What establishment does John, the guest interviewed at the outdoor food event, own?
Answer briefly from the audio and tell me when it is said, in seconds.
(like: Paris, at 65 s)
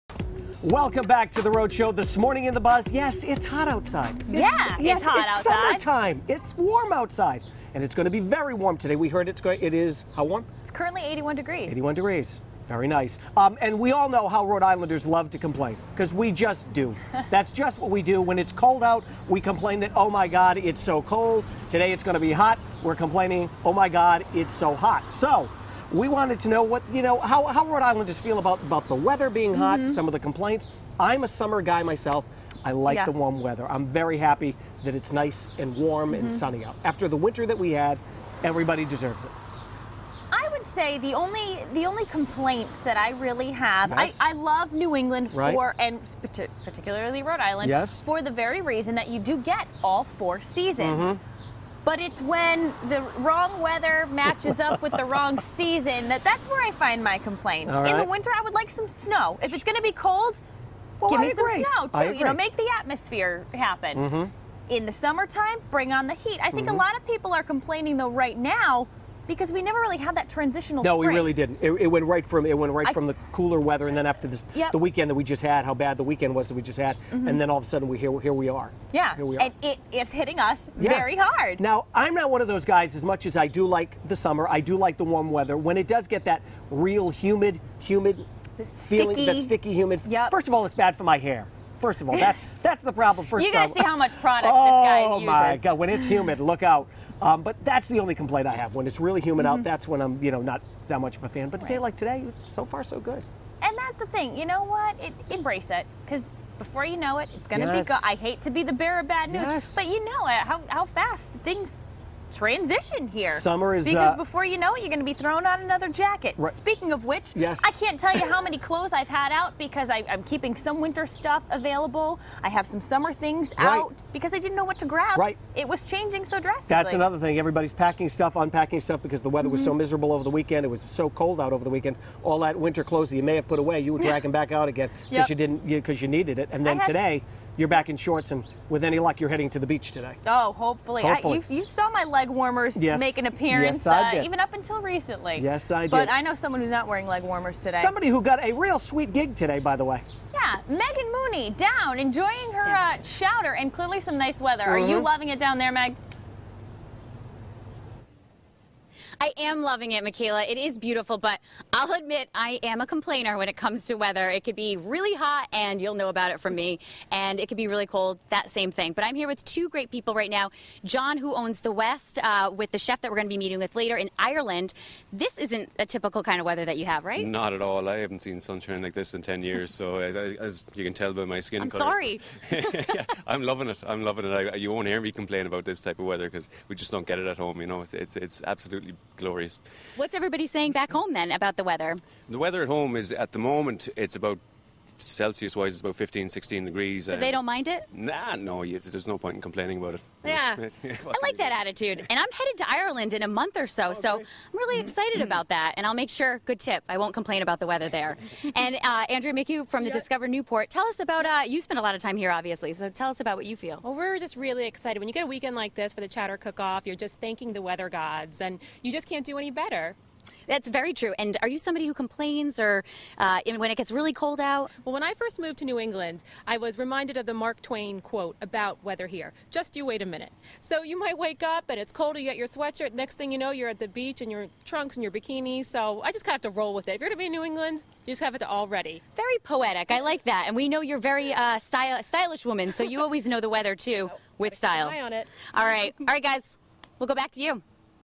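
The West, at 171 s.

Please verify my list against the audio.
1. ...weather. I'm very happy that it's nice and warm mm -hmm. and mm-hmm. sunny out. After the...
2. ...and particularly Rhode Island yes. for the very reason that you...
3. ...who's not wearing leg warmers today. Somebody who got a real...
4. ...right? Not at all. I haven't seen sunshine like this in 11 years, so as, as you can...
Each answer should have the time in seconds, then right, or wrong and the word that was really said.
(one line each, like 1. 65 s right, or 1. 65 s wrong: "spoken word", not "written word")
1. 33 s right
2. 45 s right
3. 146 s right
4. 177 s wrong: "10", not "11".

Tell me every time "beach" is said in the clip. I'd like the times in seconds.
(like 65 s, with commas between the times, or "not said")
139 s, 233 s.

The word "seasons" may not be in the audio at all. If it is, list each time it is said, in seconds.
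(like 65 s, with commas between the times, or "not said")
50 s, 55 s.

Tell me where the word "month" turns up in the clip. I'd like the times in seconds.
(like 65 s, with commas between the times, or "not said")
203 s.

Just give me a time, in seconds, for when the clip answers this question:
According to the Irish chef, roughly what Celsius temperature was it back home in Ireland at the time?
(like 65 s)
195 s.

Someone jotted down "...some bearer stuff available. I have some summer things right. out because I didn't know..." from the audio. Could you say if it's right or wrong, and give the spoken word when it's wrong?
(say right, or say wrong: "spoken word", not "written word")
wrong: "winter", not "bearer".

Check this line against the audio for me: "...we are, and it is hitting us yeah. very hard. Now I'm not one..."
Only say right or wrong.
right.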